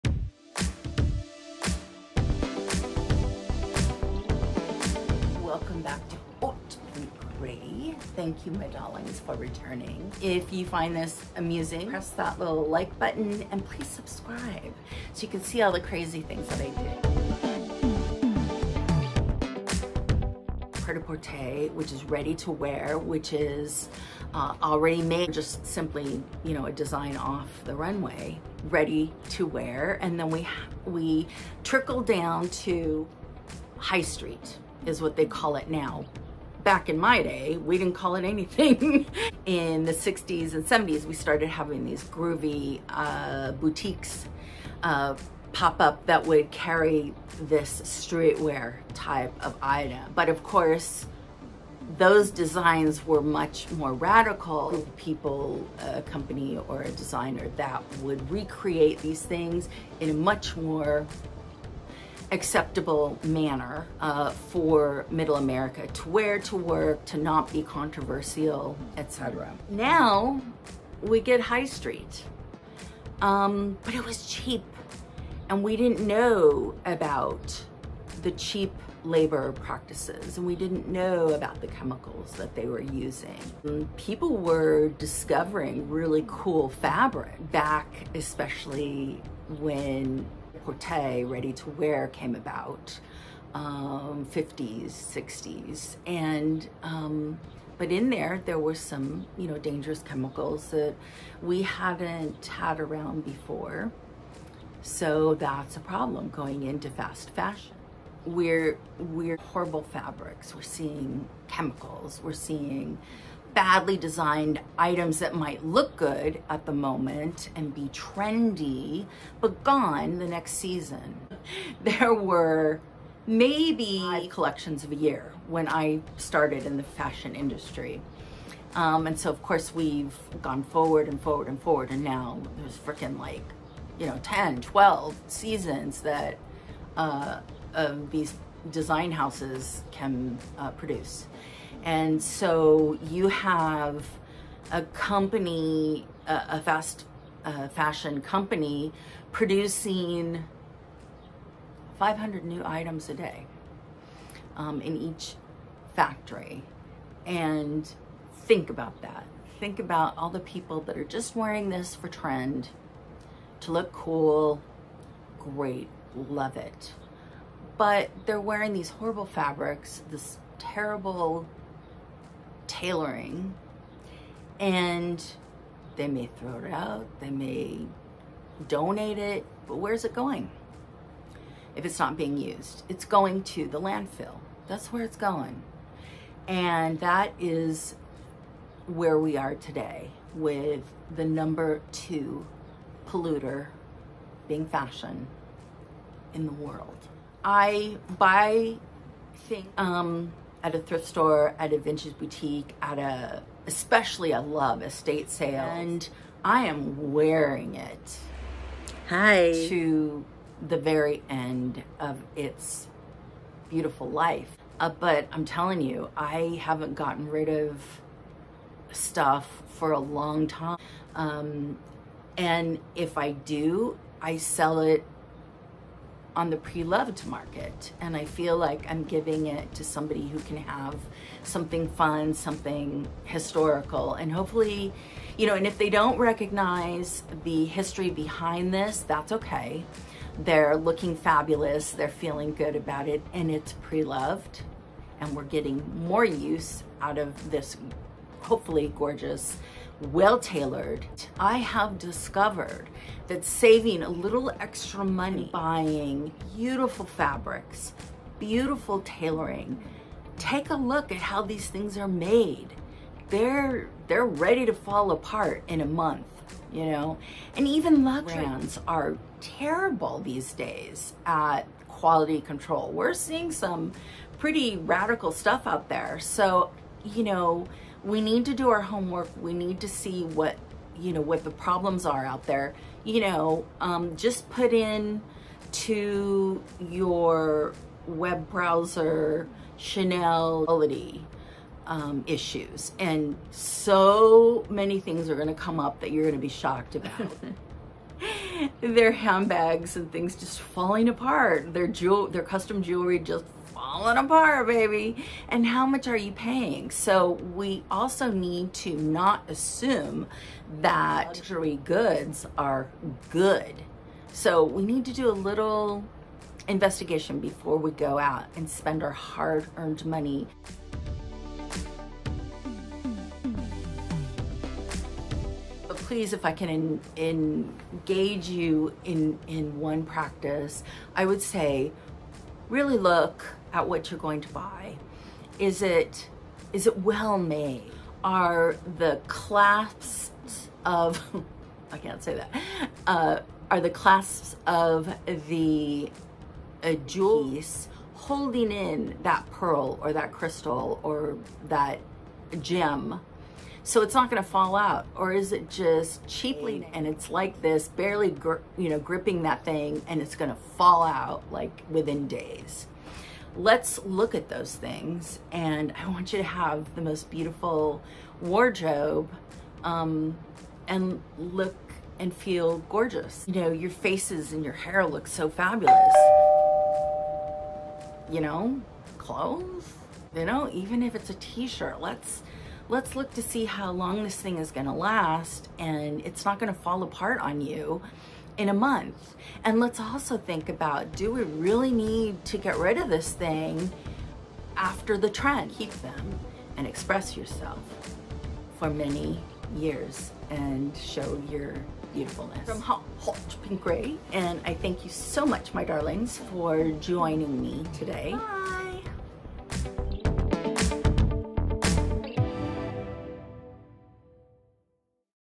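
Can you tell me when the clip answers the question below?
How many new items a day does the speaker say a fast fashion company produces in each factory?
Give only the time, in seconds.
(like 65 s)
151 s.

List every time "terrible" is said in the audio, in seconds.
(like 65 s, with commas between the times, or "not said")
170 s, 269 s.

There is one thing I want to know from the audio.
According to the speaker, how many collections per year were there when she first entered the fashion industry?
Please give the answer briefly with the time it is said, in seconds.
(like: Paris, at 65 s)
5, at 123 s.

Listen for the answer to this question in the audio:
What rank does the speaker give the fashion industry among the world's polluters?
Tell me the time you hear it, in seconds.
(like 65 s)
191 s.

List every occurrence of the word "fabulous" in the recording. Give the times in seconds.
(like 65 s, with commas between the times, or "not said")
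241 s, 375 s.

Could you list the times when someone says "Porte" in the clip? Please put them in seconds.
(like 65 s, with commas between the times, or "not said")
90 s.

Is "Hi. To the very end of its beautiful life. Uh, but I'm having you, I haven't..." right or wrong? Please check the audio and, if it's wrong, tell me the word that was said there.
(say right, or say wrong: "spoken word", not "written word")
wrong: "telling", not "having".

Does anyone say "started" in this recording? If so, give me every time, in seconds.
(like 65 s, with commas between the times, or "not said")
41 s, 126 s.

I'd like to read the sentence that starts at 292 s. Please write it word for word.
And so many things are gonna come up that you're gonna be shocked about.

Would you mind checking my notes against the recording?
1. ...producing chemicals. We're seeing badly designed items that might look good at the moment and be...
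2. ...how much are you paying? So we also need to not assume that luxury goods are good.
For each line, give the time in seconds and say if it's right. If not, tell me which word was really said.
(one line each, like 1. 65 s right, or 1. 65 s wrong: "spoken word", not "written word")
1. 110 s wrong: "seeing", not "producing"
2. 305 s right.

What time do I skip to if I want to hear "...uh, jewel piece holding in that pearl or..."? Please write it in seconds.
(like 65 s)
346 s.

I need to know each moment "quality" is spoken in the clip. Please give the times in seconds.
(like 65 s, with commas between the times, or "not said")
271 s, 290 s.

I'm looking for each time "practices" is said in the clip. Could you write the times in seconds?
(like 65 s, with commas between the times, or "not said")
79 s, 330 s.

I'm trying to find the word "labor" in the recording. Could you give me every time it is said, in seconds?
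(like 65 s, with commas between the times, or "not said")
79 s.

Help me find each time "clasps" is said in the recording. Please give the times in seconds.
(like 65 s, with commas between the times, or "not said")
339 s, 343 s.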